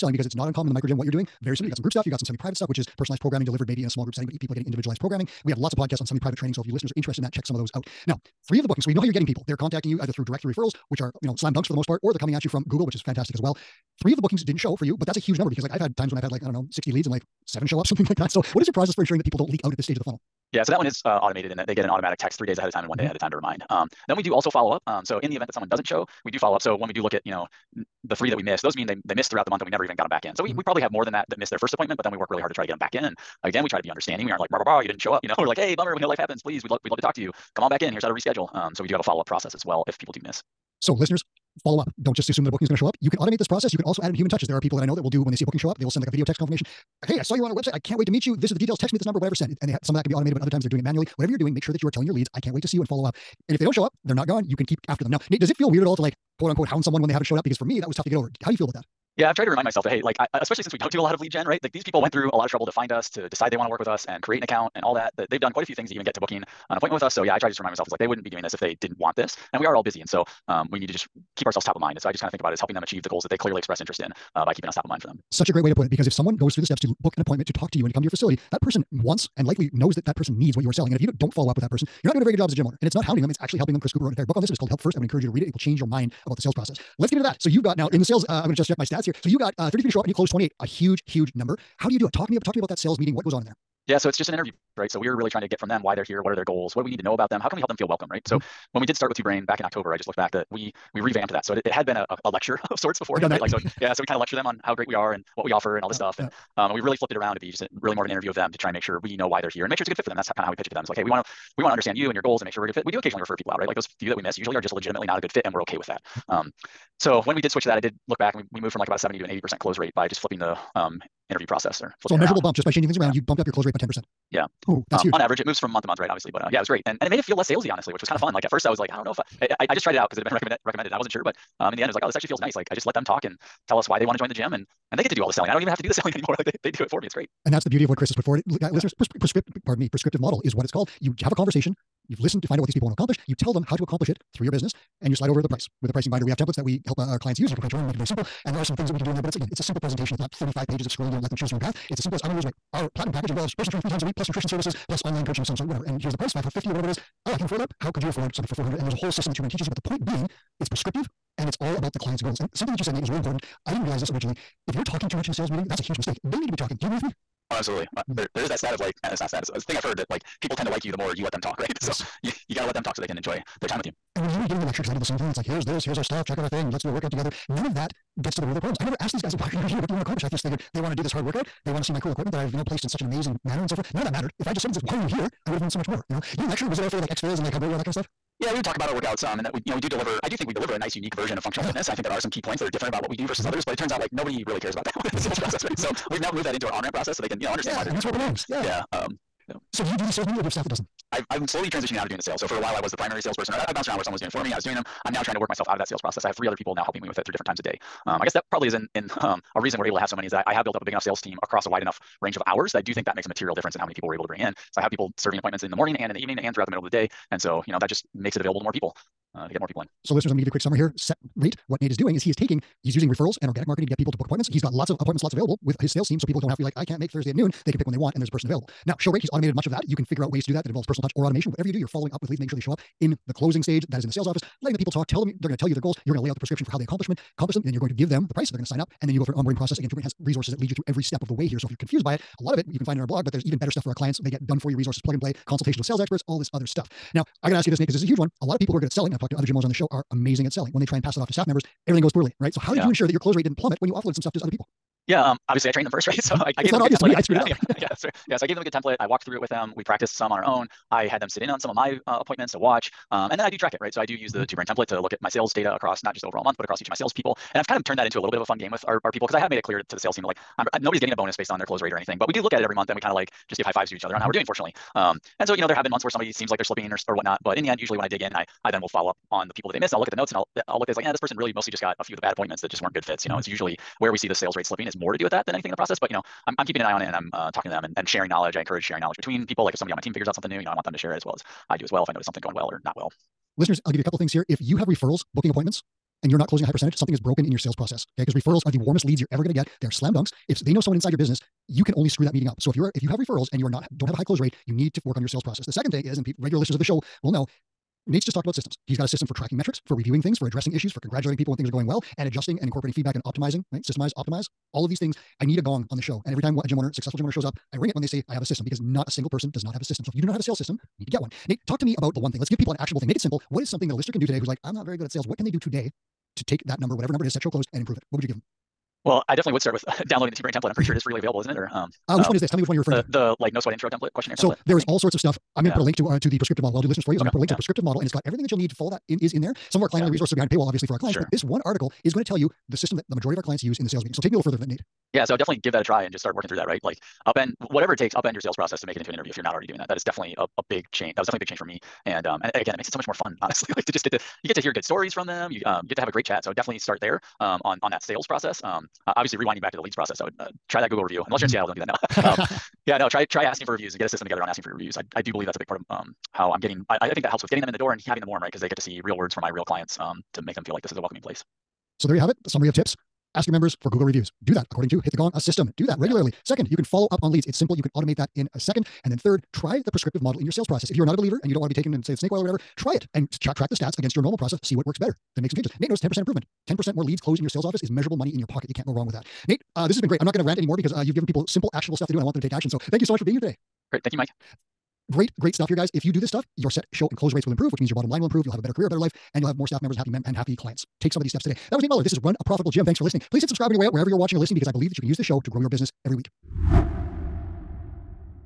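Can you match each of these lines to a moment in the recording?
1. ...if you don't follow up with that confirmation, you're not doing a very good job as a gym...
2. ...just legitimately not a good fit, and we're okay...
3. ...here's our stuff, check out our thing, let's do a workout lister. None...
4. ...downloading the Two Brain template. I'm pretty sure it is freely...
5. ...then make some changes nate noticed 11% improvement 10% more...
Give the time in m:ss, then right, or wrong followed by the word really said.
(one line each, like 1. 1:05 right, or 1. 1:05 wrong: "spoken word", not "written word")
1. 1:20 wrong: "person", not "confirmation"
2. 1:54 right
3. 2:55 wrong: "together", not "lister"
4. 5:30 right
5. 6:25 wrong: "10", not "11".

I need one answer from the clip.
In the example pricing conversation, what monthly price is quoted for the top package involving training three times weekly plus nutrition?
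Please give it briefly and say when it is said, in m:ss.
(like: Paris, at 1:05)
550, at 2:36.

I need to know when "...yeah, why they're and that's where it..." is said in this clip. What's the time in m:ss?
3:17.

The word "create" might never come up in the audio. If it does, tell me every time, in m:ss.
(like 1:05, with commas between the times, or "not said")
1:04, 2:27.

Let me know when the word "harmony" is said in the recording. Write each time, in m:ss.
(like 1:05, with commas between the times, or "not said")
not said.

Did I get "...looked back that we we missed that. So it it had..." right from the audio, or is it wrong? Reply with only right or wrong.
wrong.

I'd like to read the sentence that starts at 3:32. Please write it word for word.
think that makes a material difference in how many people we're able to bring in.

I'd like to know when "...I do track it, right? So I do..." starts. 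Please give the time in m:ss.
4:23.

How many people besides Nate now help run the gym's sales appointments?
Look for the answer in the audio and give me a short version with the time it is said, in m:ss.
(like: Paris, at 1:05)
3, at 3:26.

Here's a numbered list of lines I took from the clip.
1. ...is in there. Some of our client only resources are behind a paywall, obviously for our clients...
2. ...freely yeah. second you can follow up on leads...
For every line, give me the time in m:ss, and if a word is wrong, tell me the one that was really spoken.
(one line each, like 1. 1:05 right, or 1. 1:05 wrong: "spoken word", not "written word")
1. 5:39 right
2. 6:15 wrong: "regularly", not "freely".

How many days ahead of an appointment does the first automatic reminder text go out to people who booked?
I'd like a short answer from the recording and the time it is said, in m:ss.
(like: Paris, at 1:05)
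3, at 0:22.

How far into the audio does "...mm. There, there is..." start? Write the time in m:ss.
2:48.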